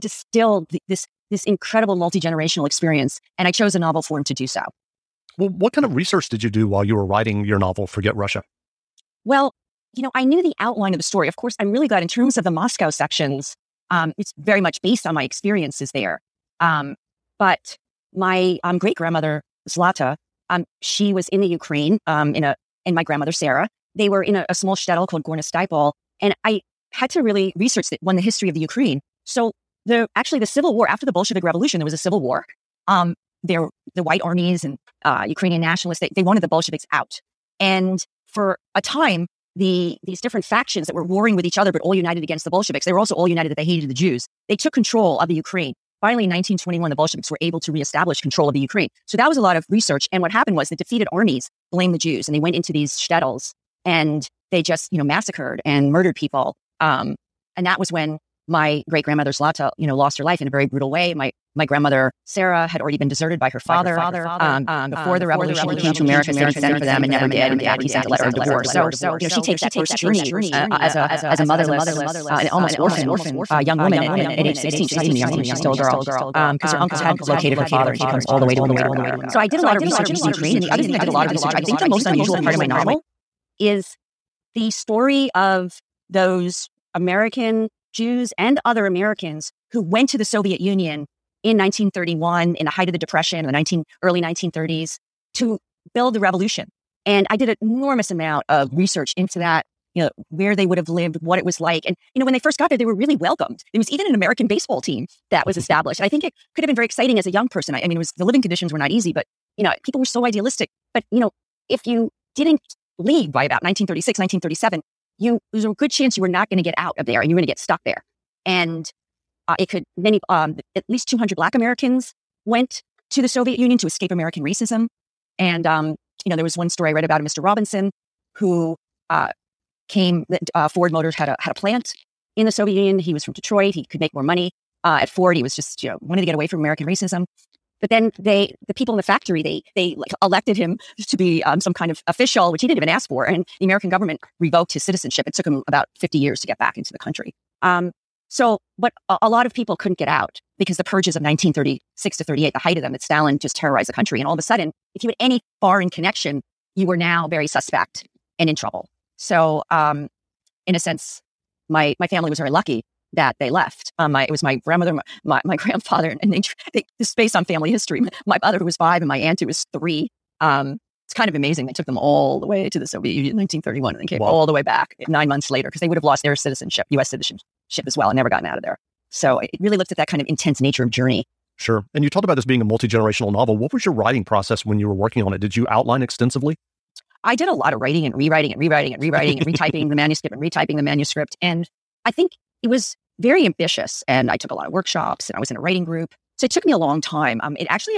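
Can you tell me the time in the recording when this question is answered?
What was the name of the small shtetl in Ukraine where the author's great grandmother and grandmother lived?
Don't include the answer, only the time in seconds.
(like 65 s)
25 s.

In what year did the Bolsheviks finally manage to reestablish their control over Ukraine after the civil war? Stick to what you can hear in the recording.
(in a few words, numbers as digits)
1921.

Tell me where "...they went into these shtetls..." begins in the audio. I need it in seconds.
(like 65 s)
52 s.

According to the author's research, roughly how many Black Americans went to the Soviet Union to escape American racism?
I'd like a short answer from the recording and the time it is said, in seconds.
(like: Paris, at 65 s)
200, at 121 s.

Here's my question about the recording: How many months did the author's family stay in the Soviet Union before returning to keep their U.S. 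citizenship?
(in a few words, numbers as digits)
9.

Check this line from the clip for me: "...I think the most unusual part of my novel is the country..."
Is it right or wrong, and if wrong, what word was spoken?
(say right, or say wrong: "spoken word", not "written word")
wrong: "story", not "country".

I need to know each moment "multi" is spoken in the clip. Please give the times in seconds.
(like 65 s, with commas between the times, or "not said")
1 s, 182 s.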